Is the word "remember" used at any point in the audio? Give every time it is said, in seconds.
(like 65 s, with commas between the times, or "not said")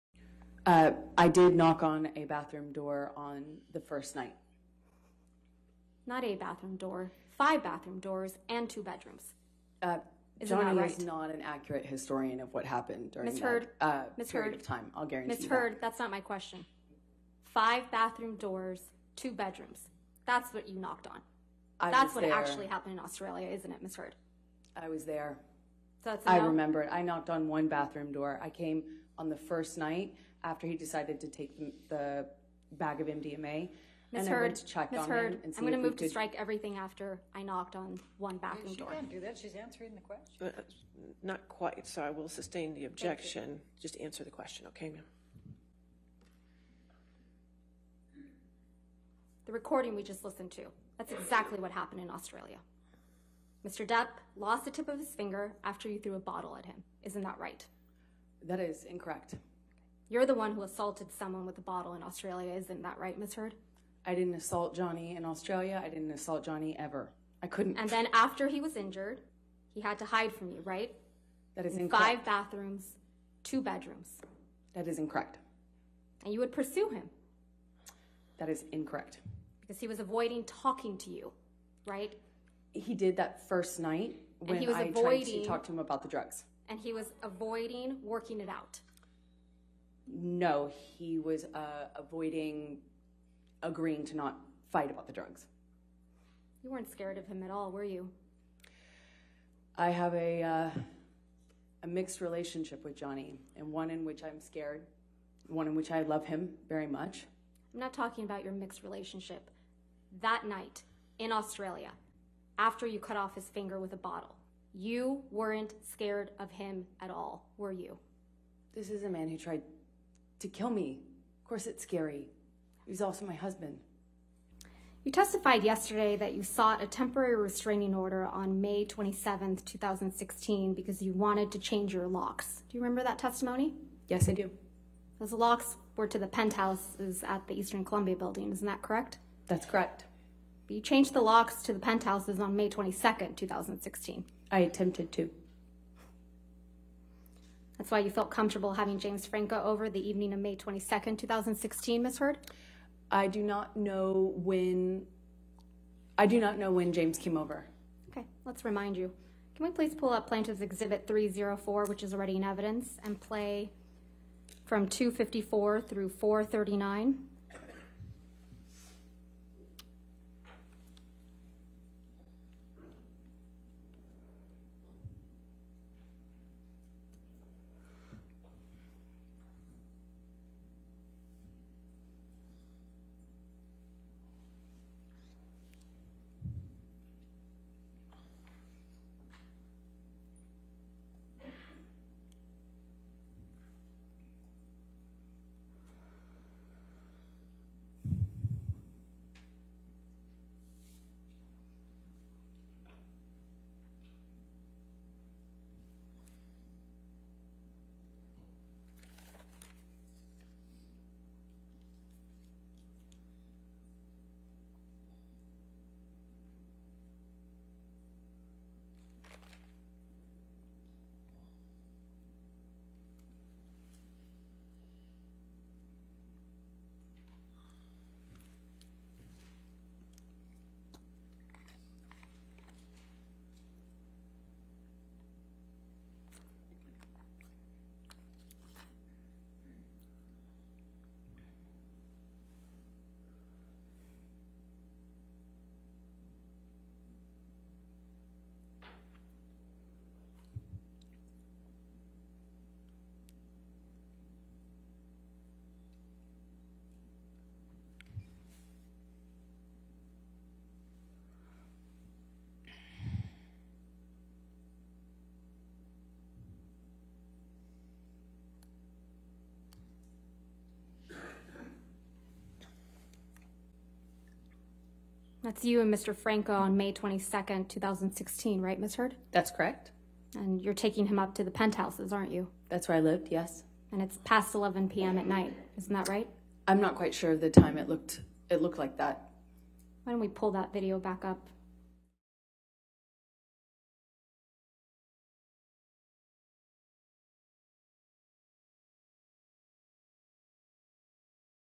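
26 s, 132 s.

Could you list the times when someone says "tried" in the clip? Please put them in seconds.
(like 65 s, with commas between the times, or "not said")
85 s, 119 s.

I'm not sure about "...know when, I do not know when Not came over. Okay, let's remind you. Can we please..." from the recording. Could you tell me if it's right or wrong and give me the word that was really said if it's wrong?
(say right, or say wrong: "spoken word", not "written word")
wrong: "James", not "Not".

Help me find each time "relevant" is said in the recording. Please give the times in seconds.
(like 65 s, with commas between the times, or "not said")
not said.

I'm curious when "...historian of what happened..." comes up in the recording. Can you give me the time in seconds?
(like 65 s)
11 s.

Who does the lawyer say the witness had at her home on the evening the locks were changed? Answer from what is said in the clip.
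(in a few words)
James Franco.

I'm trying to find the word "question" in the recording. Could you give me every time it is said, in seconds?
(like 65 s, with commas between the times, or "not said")
16 s, 40 s, 44 s.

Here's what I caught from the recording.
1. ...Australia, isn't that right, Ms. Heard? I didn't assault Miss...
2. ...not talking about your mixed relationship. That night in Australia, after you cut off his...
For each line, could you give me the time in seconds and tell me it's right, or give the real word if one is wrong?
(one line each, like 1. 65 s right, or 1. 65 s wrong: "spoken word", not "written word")
1. 62 s wrong: "Johnny", not "Miss"
2. 107 s right.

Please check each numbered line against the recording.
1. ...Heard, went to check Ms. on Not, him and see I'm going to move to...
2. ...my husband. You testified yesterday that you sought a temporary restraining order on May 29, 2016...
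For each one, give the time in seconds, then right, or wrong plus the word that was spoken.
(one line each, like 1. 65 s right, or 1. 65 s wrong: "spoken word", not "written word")
1. 34 s wrong: "Heard", not "Not"
2. 123 s wrong: "27", not "29".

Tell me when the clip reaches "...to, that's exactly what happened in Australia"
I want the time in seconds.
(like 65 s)
50 s.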